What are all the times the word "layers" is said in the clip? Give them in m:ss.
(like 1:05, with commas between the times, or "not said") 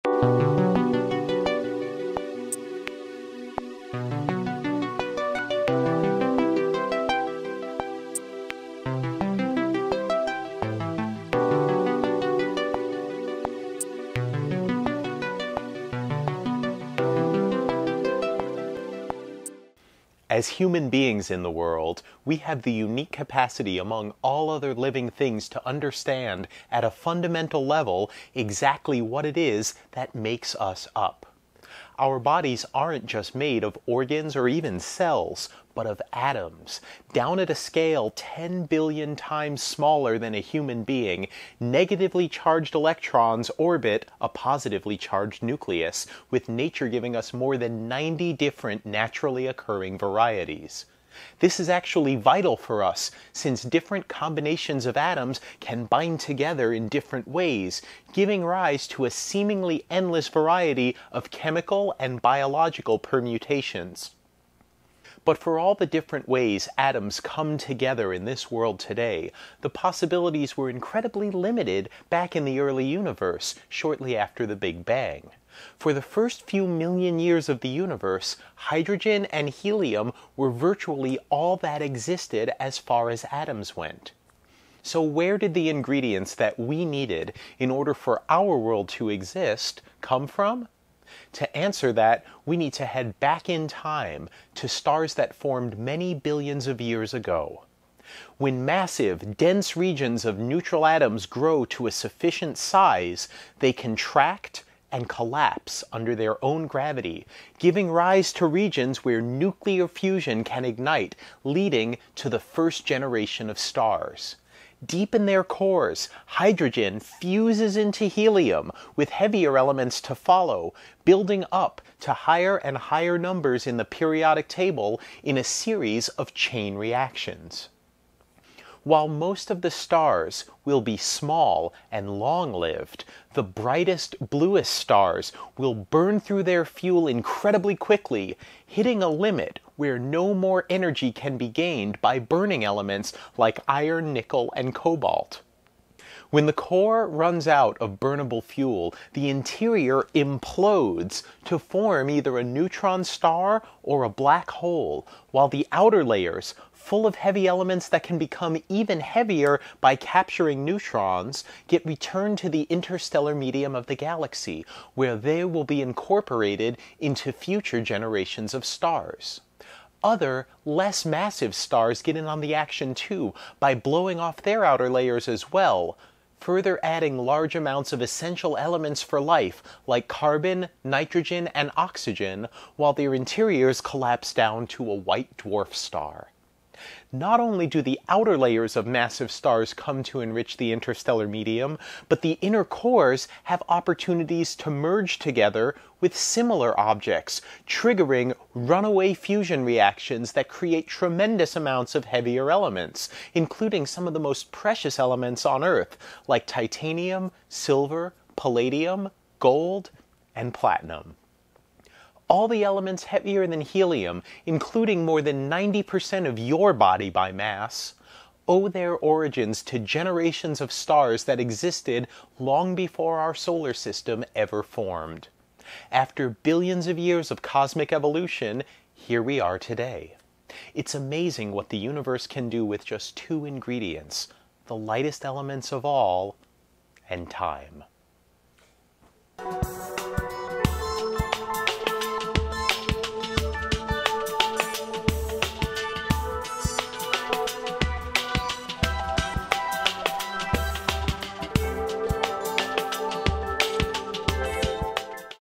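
2:36, 2:54, 3:08.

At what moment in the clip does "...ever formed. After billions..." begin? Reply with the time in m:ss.
3:44.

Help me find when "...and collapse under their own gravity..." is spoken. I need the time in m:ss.
1:44.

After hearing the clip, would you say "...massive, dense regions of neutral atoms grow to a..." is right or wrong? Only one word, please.
right.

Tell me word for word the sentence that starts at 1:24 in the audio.
So, where did the ingredients that we needed in order for our world to exist come from?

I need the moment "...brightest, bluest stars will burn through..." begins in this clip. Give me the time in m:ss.
2:13.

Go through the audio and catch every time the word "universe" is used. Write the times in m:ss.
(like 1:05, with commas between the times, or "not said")
1:12, 1:17, 3:51.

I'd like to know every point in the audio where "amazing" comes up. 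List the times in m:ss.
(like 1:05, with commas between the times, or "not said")
3:50.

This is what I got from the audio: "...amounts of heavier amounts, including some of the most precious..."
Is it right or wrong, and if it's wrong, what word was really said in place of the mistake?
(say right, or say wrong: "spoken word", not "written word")
wrong: "elements", not "amounts".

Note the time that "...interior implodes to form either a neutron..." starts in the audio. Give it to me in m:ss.
2:29.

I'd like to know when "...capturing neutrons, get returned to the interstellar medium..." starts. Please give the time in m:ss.
2:39.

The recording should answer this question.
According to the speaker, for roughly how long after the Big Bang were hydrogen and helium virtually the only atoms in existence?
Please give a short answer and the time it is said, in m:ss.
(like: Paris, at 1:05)
first few million years, at 1:16.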